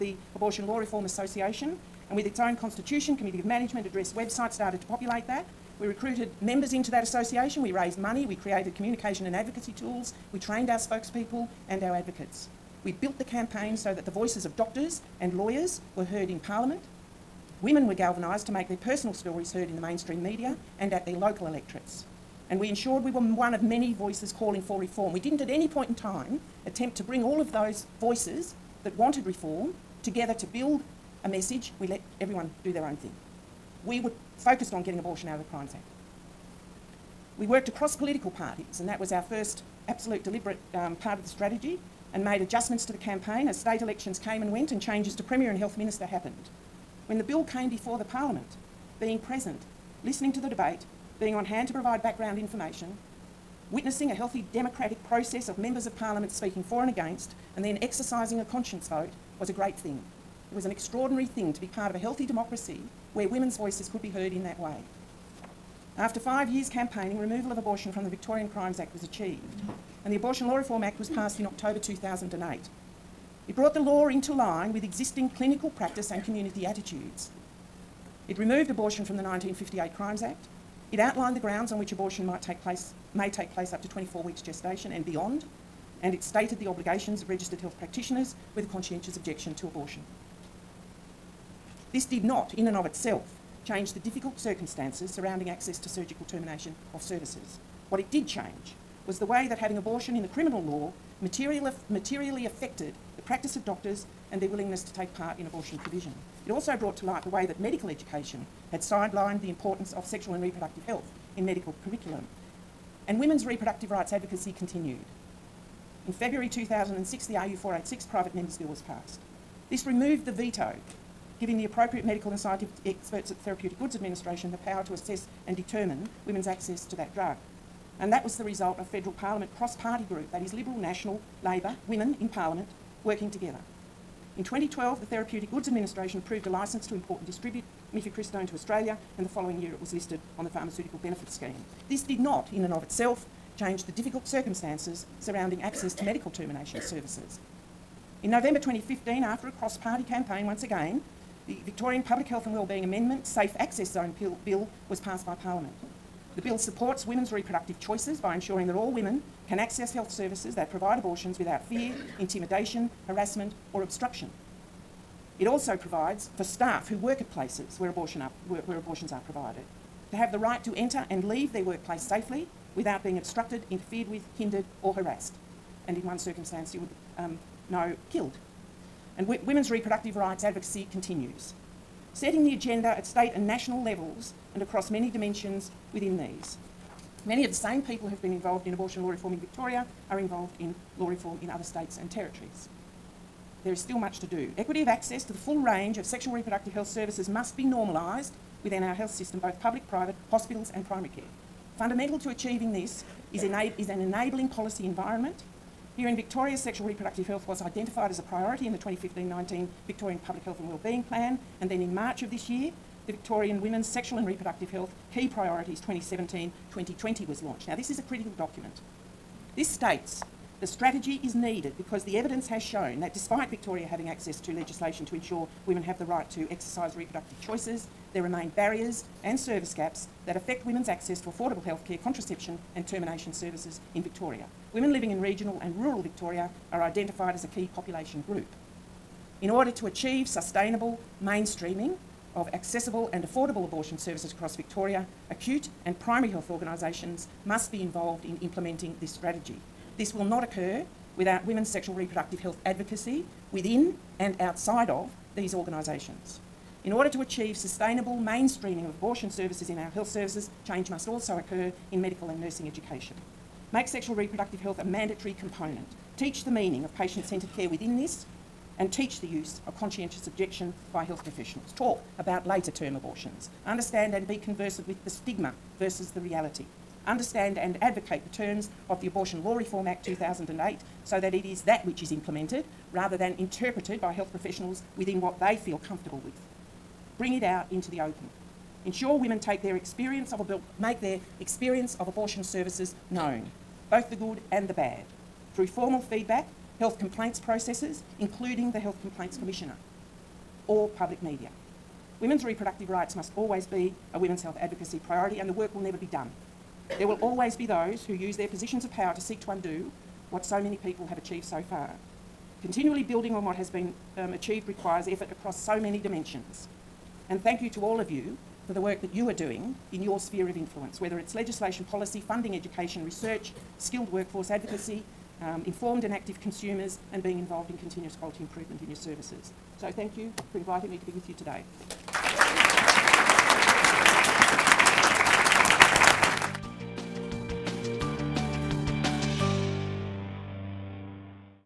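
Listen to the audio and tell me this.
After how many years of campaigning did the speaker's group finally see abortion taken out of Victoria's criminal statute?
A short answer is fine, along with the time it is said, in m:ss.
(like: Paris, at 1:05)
5, at 1:06.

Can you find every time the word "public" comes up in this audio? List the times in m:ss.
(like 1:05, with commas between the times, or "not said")
2:32, 3:19, 3:30, 5:00.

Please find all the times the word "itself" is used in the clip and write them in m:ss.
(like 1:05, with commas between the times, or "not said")
1:32, 2:22.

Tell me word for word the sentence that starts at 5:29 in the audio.
So thank you for inviting me to be with you today.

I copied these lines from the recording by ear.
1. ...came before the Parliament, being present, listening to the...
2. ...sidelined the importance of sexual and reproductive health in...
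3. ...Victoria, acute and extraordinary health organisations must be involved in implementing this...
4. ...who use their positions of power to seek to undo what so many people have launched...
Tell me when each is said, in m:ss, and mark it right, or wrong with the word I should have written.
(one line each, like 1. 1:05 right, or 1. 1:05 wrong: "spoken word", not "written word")
1. 0:47 right
2. 1:48 right
3. 4:04 wrong: "primary", not "extraordinary"
4. 5:08 wrong: "achieved", not "launched".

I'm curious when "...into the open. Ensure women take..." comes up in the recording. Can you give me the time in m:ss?
4:47.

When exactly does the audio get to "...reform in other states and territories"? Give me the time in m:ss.
3:11.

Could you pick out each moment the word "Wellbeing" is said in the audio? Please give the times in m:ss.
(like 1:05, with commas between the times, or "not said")
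2:32, 3:30.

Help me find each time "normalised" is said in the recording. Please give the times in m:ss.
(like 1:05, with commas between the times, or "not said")
3:17.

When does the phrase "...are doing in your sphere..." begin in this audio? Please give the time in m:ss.
5:19.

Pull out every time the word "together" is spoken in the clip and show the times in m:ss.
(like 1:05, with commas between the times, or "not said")
0:30, 2:13.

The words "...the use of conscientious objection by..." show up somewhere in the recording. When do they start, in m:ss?
4:29.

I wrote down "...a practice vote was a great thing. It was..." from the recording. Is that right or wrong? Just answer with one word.
wrong.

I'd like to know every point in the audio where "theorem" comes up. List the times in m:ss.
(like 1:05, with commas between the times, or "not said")
not said.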